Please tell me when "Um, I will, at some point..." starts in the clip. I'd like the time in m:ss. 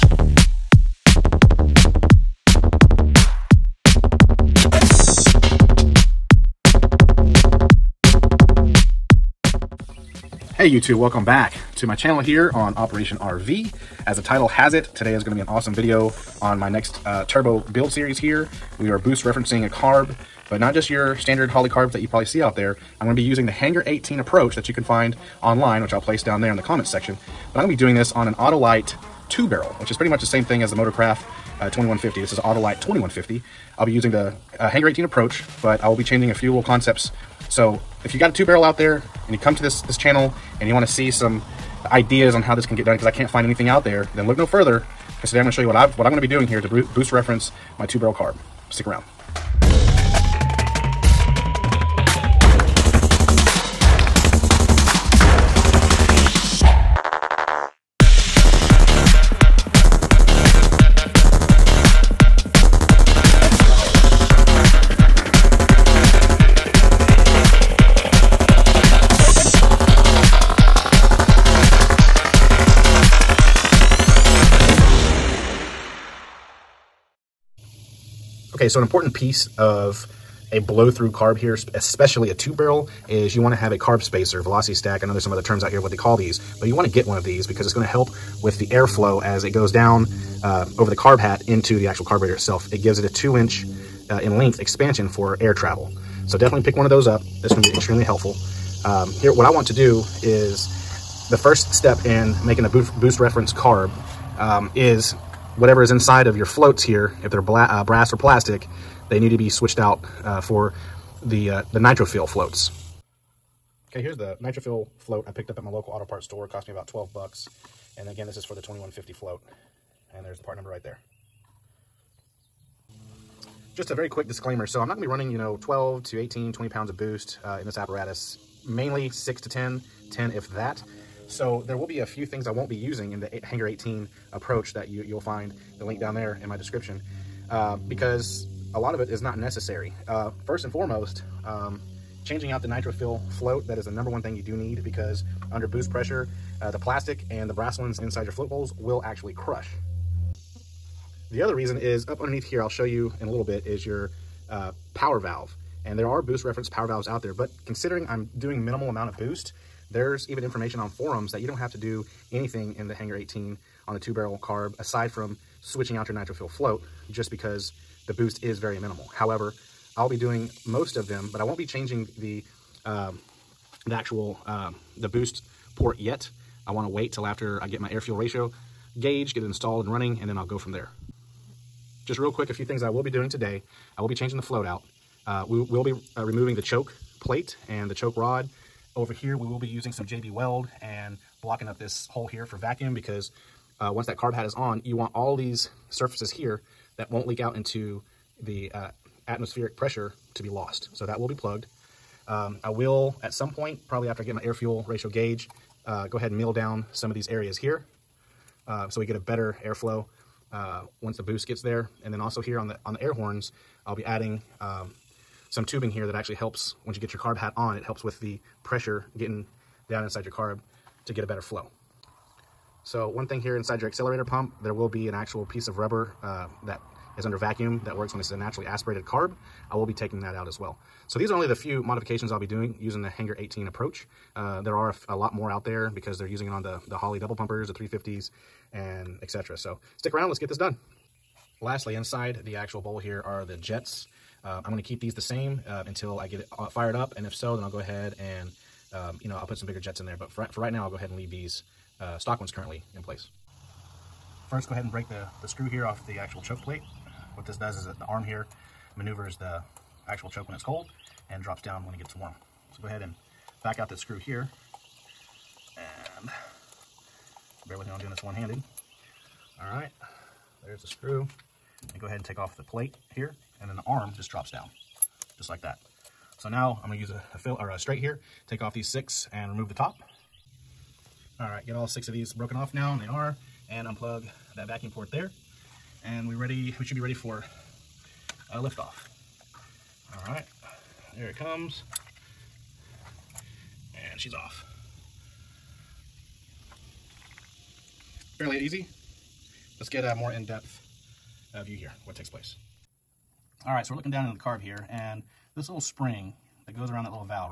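3:22.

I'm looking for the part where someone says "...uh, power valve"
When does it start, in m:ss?
2:34.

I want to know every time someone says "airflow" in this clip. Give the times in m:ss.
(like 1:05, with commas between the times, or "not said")
1:28, 3:29.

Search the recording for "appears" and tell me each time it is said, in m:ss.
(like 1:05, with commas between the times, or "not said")
not said.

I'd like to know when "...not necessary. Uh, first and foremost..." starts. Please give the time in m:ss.
2:19.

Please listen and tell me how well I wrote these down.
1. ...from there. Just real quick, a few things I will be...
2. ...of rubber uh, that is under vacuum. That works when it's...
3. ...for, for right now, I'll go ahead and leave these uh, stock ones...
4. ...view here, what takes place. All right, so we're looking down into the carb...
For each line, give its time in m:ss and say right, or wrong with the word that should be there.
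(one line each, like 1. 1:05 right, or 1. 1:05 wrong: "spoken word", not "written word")
1. 3:00 right
2. 3:45 right
3. 4:10 right
4. 5:01 right.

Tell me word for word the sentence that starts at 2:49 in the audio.
However, I'll be doing most of them, but I won't be changing the um, the actual um, the boost port yet.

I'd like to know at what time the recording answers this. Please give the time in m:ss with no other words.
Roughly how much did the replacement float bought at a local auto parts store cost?
1:56.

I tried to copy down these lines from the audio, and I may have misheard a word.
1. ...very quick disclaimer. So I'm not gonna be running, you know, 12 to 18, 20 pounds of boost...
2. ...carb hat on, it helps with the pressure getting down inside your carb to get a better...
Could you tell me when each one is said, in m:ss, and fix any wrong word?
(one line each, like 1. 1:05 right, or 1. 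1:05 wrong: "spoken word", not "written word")
1. 2:03 right
2. 3:37 right.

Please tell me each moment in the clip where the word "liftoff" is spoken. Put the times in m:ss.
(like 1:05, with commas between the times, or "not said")
4:48.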